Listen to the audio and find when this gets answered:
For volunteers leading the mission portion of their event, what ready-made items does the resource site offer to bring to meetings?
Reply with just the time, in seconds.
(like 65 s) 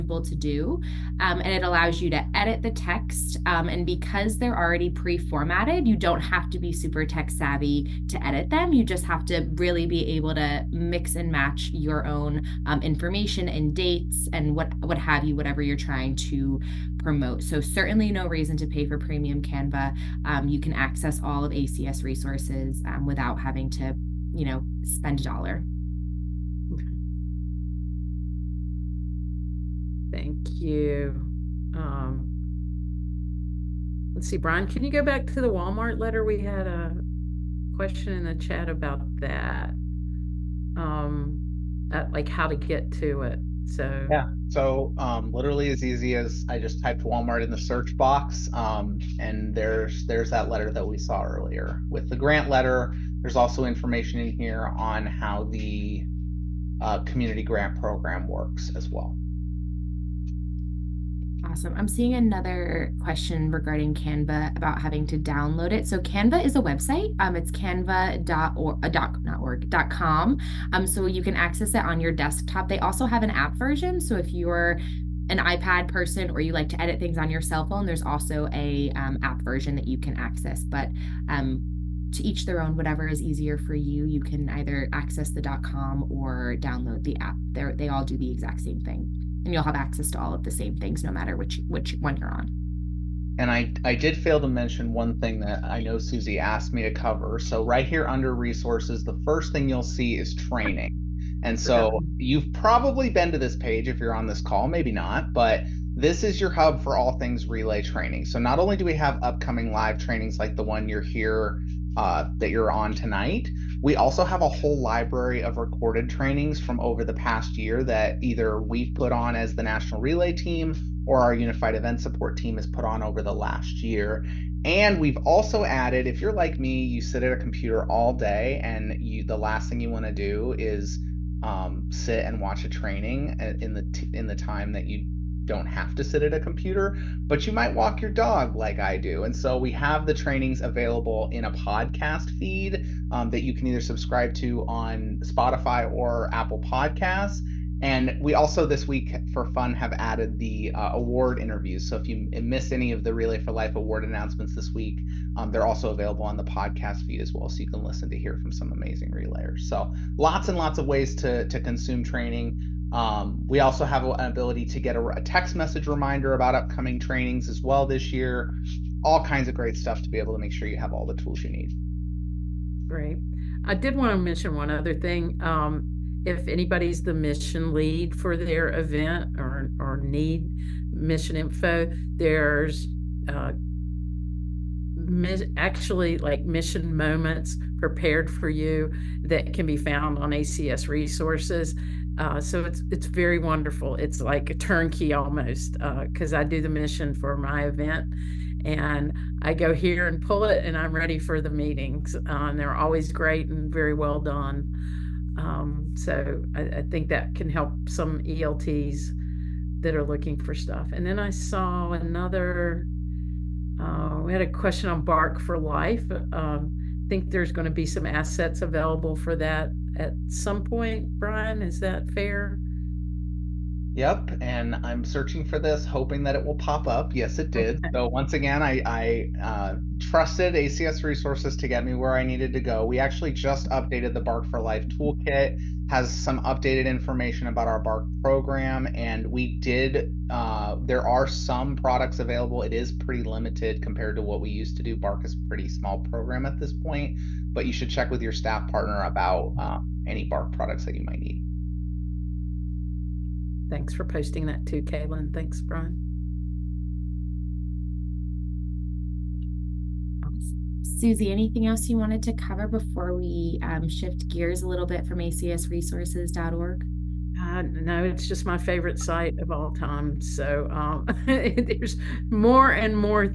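186 s.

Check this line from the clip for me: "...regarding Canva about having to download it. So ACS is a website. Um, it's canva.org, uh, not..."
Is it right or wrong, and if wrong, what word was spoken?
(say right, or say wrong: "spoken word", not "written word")
wrong: "Canva", not "ACS".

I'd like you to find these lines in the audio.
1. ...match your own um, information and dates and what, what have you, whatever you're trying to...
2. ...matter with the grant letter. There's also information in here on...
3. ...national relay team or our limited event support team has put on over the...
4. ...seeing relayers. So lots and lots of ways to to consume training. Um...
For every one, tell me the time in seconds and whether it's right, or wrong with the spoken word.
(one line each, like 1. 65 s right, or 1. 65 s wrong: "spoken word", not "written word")
1. 11 s right
2. 51 s wrong: "earlier", not "matter"
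3. 119 s wrong: "unified", not "limited"
4. 158 s wrong: "amazing", not "seeing".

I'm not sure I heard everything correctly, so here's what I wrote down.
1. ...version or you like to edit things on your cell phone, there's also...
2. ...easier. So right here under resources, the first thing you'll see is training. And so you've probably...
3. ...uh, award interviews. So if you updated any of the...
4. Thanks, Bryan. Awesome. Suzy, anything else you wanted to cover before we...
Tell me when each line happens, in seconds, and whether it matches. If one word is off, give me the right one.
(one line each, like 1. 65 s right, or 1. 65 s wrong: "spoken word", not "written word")
1. 75 s wrong: "person", not "version"
2. 96 s wrong: "cover", not "easier"
3. 150 s wrong: "missed", not "updated"
4. 255 s right.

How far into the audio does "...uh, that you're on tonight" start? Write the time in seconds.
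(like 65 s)
111 s.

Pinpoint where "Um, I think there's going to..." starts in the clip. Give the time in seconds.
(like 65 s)
216 s.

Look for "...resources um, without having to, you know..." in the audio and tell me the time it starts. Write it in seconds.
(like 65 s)
22 s.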